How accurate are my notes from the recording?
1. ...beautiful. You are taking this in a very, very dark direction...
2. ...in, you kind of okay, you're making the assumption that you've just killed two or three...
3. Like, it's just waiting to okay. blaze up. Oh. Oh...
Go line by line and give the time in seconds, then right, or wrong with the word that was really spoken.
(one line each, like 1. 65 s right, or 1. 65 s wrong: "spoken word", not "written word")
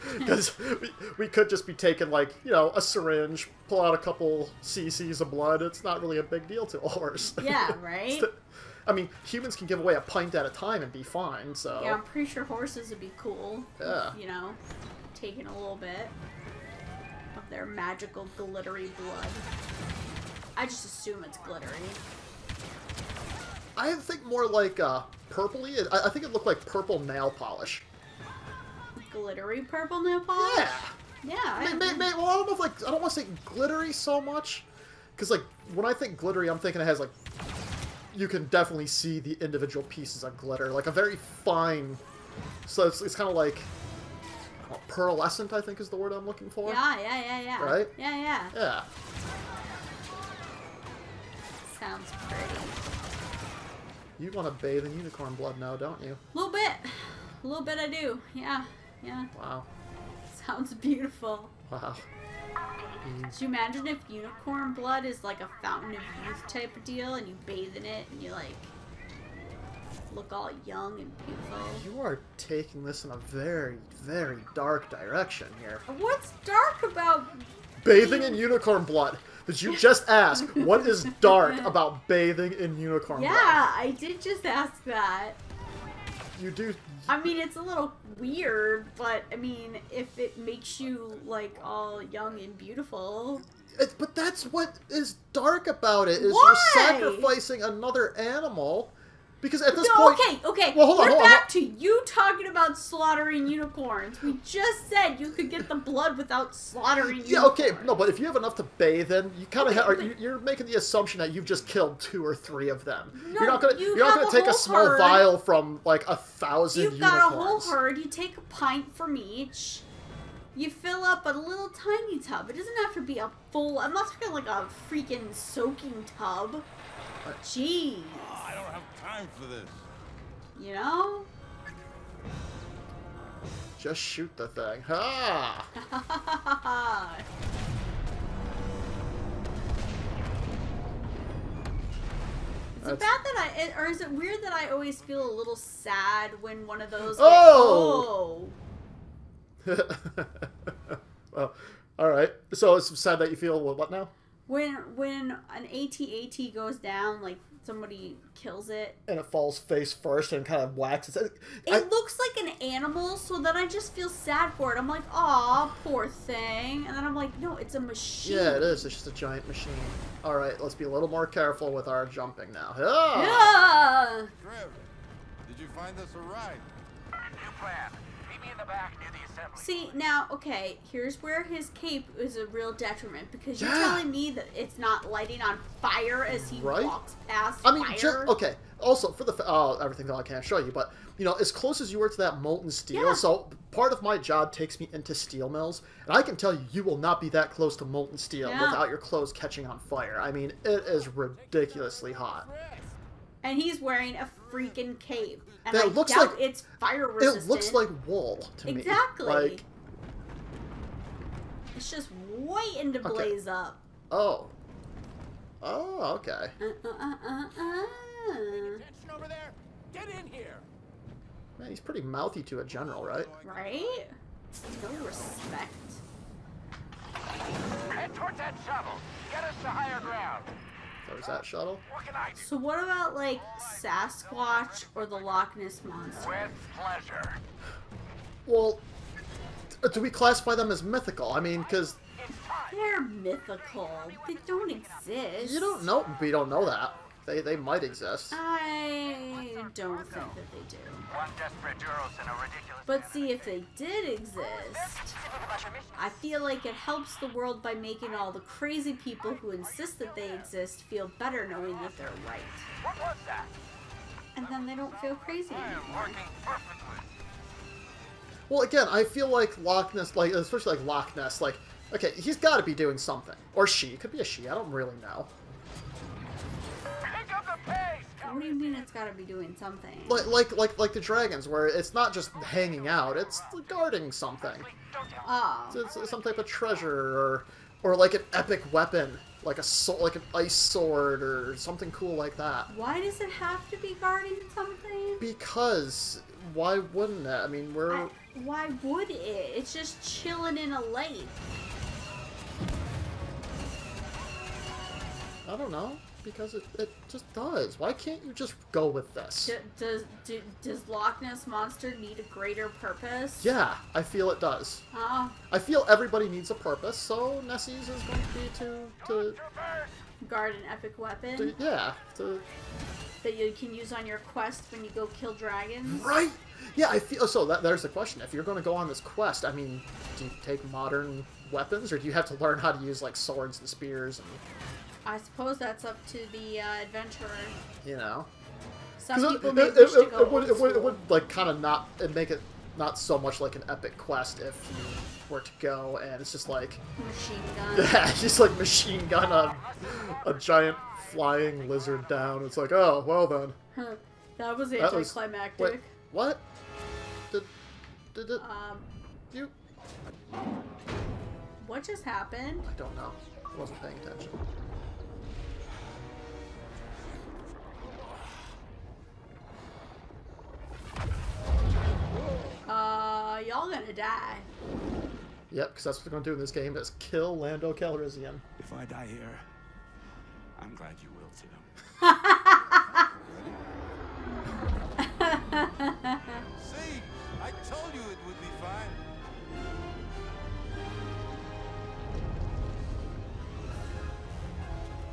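1. 71 s right
2. 109 s right
3. 209 s right.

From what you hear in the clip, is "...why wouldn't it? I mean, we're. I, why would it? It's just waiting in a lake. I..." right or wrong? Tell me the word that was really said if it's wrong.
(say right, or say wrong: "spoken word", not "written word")
wrong: "chilling", not "waiting".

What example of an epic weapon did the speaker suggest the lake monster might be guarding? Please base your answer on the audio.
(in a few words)
an ice sword.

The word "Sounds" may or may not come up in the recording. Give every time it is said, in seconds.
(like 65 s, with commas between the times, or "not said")
51 s, 60 s.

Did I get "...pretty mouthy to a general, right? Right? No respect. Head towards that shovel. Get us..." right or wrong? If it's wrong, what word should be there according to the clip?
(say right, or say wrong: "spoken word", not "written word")
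right.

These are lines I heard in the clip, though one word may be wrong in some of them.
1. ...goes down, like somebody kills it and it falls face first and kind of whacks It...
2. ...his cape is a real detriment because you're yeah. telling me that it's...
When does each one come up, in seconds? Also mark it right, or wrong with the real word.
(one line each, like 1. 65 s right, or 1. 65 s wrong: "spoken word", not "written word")
1. 156 s right
2. 181 s right.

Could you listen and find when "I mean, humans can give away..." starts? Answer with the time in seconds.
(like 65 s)
8 s.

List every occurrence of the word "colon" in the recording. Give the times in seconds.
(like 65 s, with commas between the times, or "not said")
not said.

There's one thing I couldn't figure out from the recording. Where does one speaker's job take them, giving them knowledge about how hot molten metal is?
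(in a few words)
steel mills.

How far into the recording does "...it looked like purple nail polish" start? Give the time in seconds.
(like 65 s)
26 s.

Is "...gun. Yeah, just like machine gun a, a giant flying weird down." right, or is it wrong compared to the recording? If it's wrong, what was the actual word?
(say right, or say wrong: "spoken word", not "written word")
wrong: "lizard", not "weird".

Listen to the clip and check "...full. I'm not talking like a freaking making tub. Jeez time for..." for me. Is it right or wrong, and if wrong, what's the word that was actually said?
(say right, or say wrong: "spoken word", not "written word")
wrong: "soaking", not "making".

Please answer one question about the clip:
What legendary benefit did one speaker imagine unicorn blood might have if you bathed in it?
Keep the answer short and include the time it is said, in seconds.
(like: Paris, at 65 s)
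fountain of youth, at 65 s.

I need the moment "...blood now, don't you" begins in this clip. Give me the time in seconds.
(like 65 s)
55 s.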